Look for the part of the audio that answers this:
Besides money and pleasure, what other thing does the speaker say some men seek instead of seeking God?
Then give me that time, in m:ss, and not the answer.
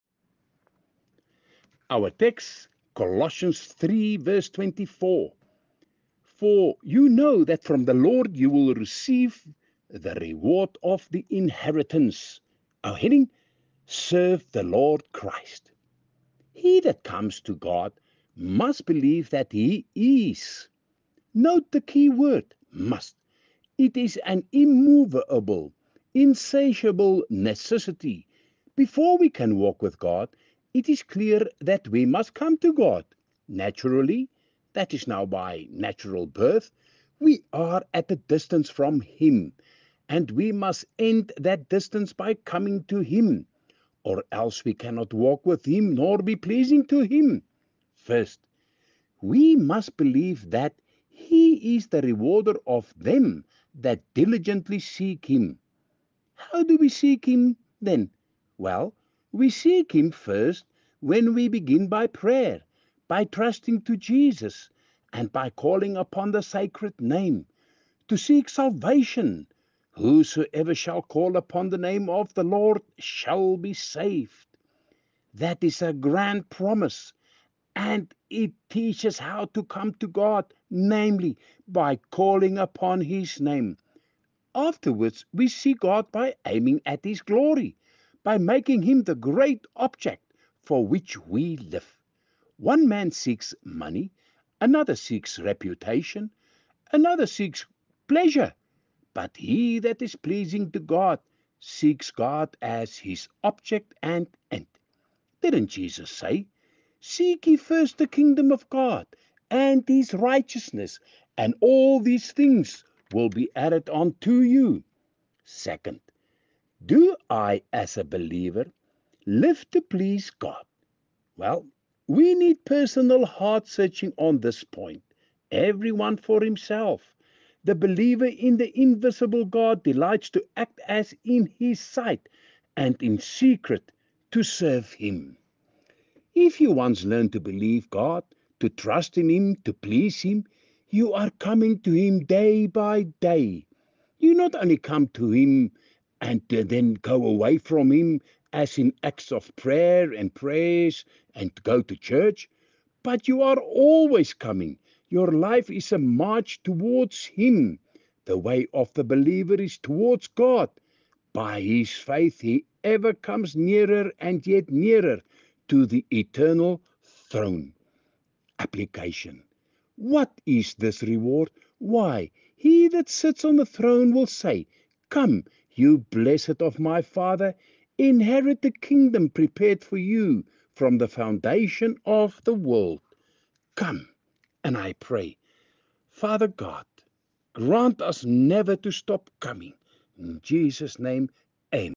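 1:35.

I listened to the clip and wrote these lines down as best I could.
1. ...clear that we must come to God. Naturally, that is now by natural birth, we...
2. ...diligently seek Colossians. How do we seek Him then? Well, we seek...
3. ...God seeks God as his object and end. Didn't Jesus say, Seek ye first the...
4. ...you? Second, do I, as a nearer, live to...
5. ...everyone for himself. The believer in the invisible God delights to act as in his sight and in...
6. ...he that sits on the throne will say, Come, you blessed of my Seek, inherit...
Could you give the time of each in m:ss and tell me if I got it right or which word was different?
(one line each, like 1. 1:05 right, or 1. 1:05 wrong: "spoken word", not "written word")
1. 0:31 right
2. 0:54 wrong: "Him", not "Colossians"
3. 1:40 right
4. 1:54 wrong: "believer", not "nearer"
5. 2:05 right
6. 2:52 wrong: "Father", not "Seek".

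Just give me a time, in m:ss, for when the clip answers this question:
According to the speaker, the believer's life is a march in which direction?
2:39.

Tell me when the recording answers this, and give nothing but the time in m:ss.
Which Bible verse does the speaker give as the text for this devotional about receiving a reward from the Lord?
0:02.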